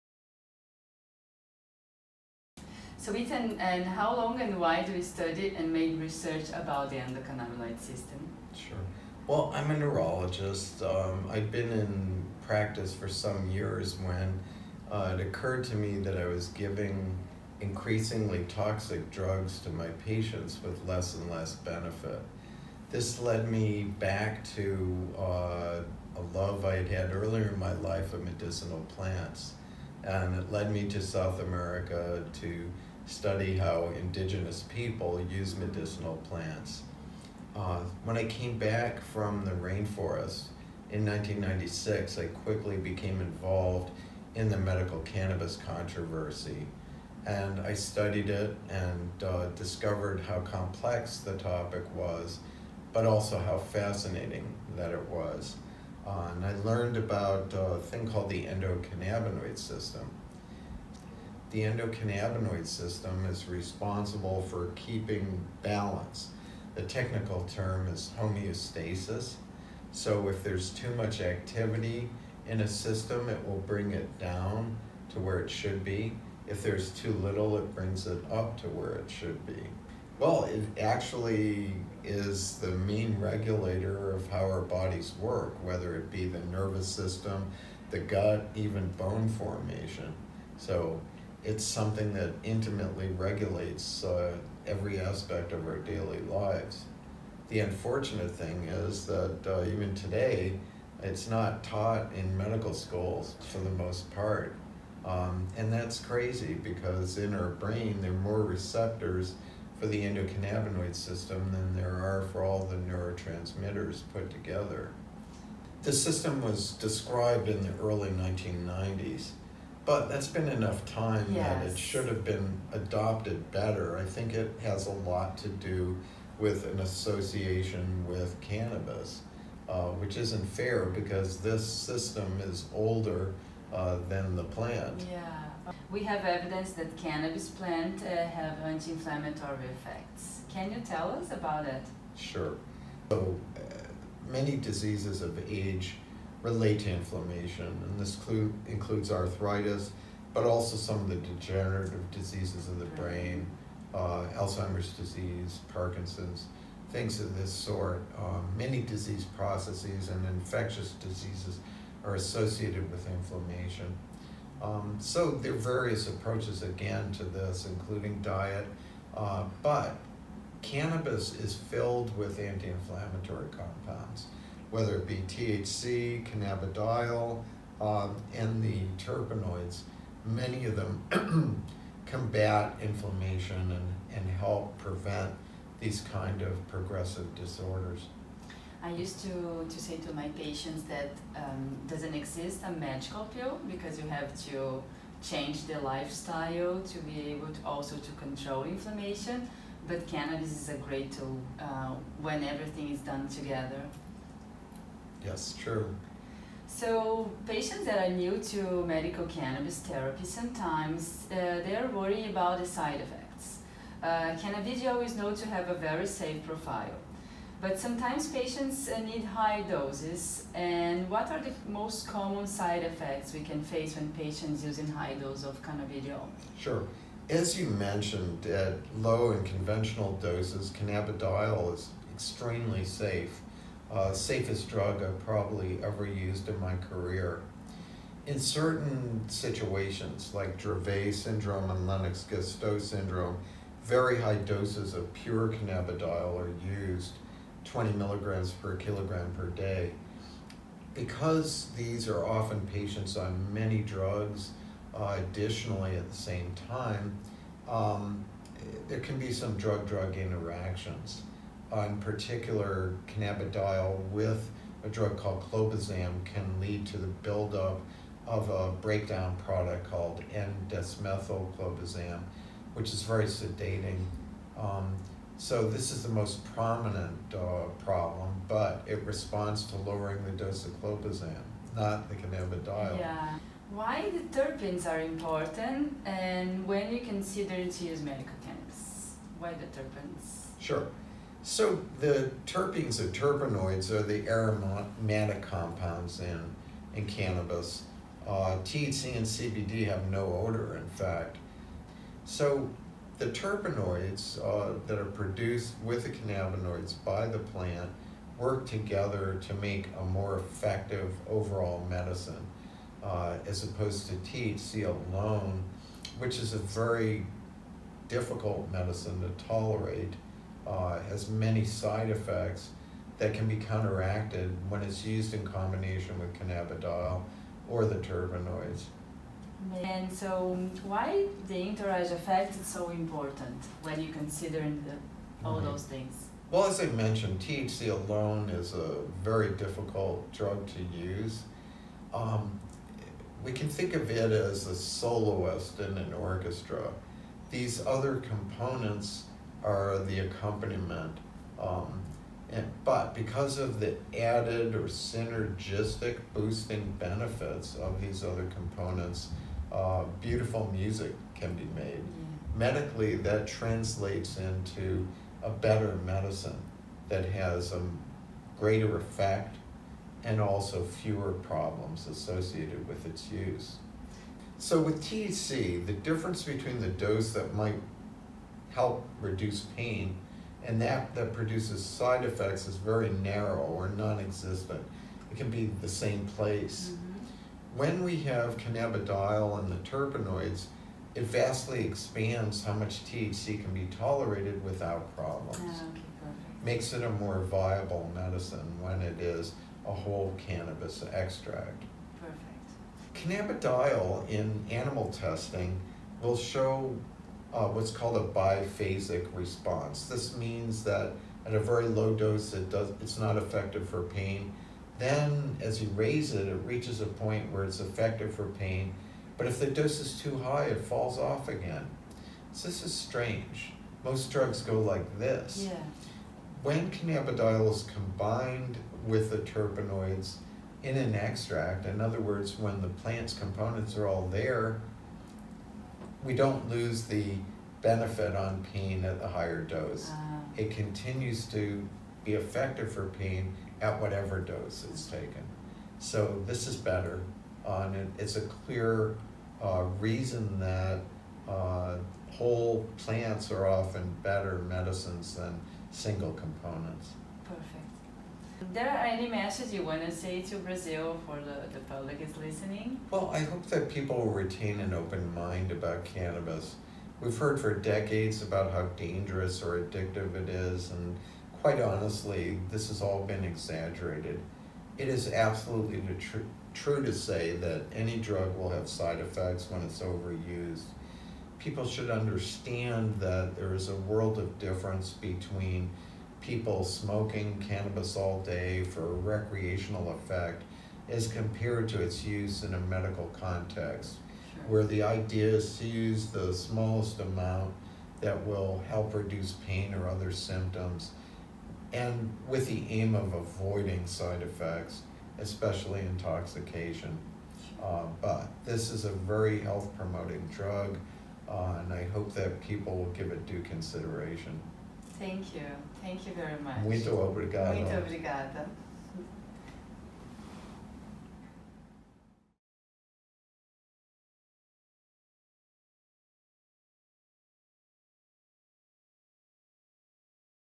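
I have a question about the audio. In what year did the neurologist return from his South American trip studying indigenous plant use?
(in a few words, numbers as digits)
1996.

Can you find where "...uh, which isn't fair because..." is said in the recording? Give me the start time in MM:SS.
02:09.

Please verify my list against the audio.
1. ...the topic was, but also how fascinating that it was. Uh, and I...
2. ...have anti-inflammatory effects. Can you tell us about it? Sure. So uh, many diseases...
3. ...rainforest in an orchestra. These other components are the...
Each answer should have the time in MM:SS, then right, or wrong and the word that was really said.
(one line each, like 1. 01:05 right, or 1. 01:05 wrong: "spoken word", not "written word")
1. 00:51 right
2. 02:18 right
3. 05:44 wrong: "soloist", not "rainforest".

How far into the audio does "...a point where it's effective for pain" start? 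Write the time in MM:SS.
06:57.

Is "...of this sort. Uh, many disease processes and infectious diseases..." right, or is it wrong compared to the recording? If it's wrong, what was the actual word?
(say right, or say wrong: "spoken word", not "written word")
right.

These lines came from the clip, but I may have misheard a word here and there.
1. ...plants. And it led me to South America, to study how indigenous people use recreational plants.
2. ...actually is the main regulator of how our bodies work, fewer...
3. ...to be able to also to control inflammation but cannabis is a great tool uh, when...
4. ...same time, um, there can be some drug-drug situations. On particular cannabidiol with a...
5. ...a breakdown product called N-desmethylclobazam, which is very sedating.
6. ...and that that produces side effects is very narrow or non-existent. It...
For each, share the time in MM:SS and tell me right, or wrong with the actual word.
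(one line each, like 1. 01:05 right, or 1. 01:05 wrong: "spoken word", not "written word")
1. 00:28 wrong: "medicinal", not "recreational"
2. 01:20 wrong: "whether", not "fewer"
3. 03:16 right
4. 04:16 wrong: "interactions", not "situations"
5. 04:28 right
6. 06:20 right.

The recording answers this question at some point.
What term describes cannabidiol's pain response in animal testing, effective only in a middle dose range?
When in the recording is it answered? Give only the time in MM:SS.
06:48.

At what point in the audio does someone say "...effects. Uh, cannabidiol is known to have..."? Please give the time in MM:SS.
03:33.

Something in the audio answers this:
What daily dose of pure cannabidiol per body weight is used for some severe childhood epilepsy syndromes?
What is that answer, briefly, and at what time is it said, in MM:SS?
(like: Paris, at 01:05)
20 mg/kg per day, at 04:07.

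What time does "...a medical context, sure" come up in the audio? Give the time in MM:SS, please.
08:12.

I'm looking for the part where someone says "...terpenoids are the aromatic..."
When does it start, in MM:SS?
04:53.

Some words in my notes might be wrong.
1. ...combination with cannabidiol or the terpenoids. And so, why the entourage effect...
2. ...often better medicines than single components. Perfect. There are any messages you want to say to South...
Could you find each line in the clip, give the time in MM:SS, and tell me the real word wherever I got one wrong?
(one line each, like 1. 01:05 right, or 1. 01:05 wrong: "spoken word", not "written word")
1. 05:25 right
2. 07:33 wrong: "Brazil", not "South".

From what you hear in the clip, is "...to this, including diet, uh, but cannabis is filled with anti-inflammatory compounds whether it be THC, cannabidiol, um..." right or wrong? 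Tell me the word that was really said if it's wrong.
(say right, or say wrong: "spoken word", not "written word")
right.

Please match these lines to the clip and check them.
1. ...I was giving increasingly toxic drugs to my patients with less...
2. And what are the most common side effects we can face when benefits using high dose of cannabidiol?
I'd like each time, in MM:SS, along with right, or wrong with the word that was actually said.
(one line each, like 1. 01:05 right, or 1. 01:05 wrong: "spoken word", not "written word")
1. 00:16 right
2. 03:40 wrong: "patients", not "benefits".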